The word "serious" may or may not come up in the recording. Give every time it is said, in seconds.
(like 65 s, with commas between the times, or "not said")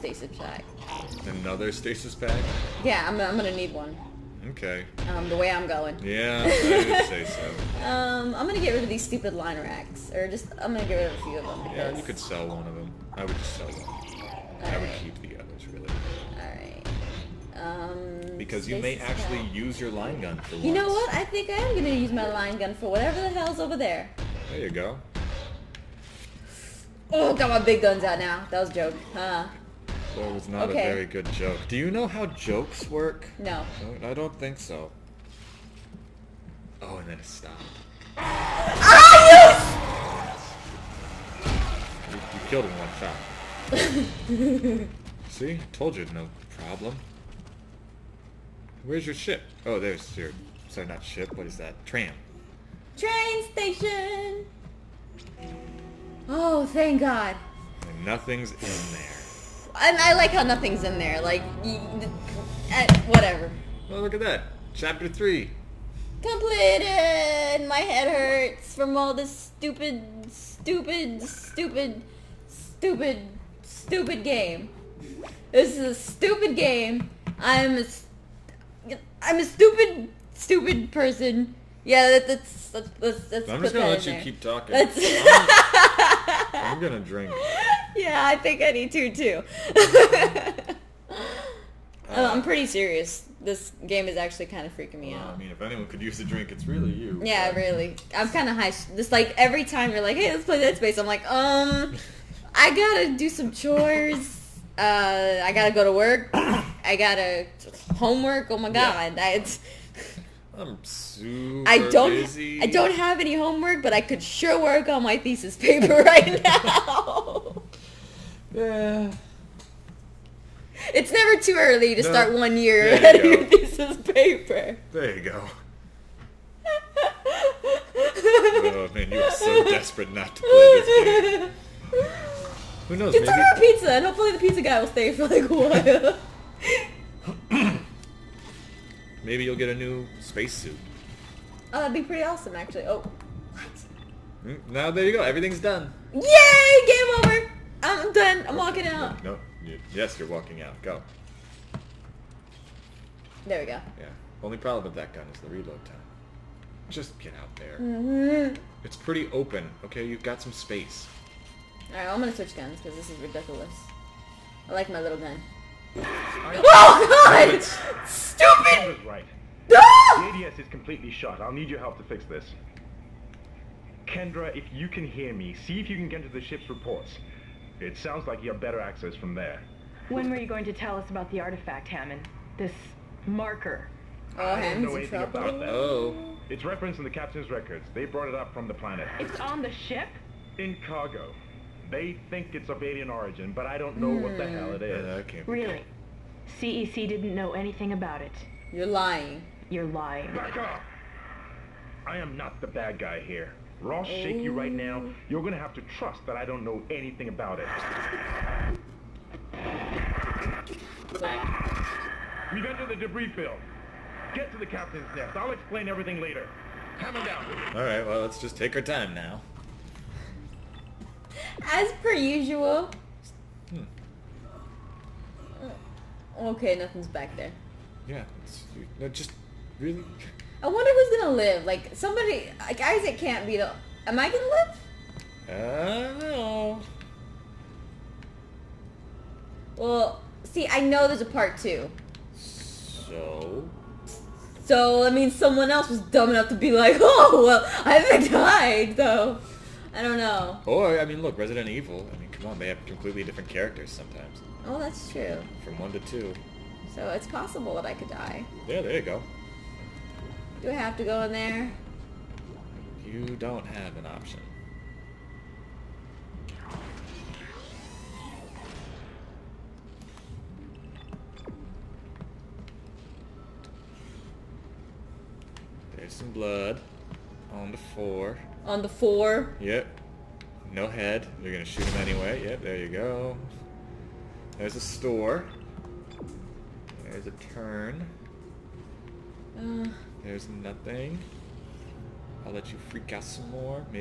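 92 s.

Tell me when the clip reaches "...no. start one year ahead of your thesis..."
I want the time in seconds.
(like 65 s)
122 s.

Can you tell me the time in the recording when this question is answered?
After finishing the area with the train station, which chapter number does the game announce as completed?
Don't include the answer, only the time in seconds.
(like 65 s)
64 s.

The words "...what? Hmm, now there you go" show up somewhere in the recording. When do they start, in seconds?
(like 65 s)
143 s.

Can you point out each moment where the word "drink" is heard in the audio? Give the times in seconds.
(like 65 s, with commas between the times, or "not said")
86 s, 96 s.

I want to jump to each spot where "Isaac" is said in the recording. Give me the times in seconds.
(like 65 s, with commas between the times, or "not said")
232 s, 247 s.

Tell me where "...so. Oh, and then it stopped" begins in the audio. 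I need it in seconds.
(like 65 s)
34 s.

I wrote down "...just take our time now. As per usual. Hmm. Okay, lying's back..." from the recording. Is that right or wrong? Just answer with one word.
wrong.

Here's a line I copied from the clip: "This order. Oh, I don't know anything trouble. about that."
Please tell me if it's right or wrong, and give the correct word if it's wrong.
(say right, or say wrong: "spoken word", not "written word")
wrong: "marker", not "order".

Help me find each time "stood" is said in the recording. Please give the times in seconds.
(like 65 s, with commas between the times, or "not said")
not said.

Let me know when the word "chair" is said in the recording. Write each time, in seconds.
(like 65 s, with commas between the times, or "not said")
not said.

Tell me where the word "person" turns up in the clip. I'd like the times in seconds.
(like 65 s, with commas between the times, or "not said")
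80 s.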